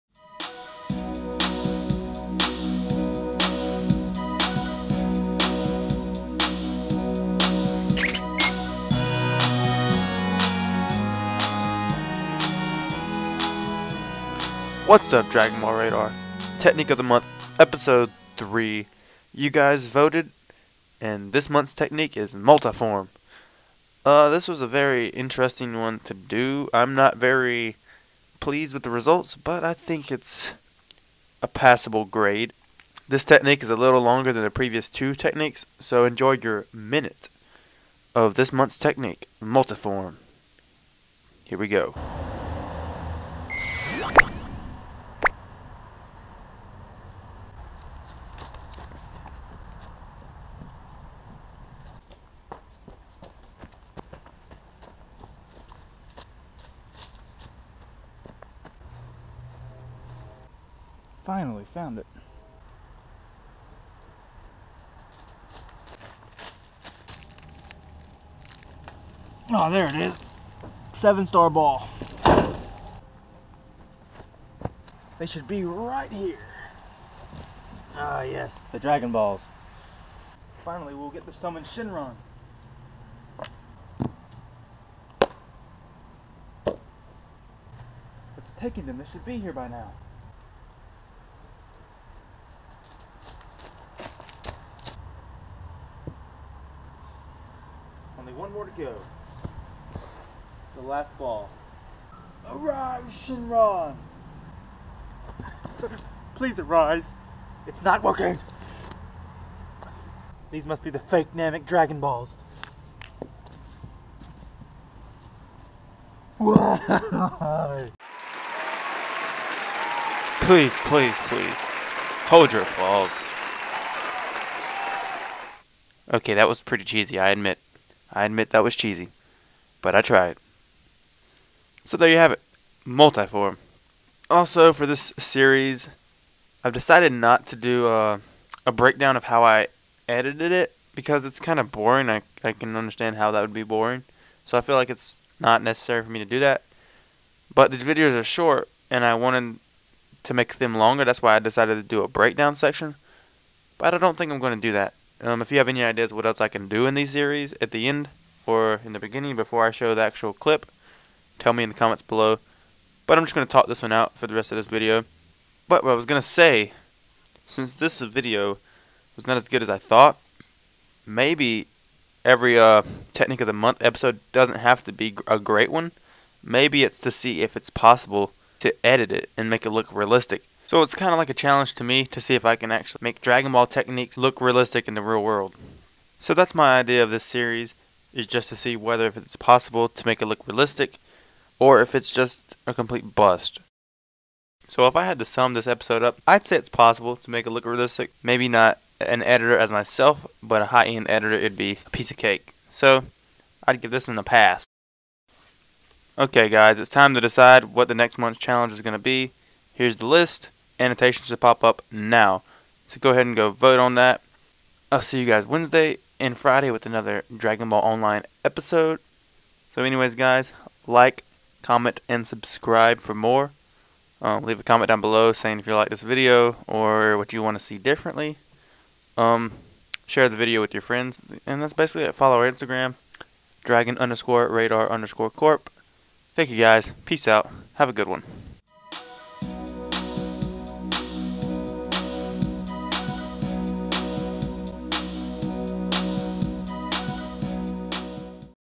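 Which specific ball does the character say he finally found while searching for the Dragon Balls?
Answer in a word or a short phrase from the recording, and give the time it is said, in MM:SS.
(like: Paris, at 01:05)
Seven star ball, at 01:10.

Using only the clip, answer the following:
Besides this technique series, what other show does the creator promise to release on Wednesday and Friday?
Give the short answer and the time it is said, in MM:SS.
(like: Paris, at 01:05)
Dragon Ball Online, at 03:37.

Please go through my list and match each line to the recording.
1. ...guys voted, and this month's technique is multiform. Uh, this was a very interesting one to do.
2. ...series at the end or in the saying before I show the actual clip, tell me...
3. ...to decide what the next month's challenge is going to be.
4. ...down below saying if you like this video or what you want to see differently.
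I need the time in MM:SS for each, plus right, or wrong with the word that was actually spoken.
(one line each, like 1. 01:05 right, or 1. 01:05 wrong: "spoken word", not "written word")
1. 00:19 right
2. 02:37 wrong: "beginning", not "saying"
3. 03:27 right
4. 03:44 right.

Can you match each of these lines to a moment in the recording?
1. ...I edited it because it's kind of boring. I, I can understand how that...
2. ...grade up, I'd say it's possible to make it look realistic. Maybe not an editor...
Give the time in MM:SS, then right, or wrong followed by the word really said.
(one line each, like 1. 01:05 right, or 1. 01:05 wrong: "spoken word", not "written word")
1. 02:19 right
2. 03:15 wrong: "episode", not "grade".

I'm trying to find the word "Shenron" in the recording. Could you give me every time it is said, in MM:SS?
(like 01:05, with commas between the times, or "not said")
01:21, 01:43.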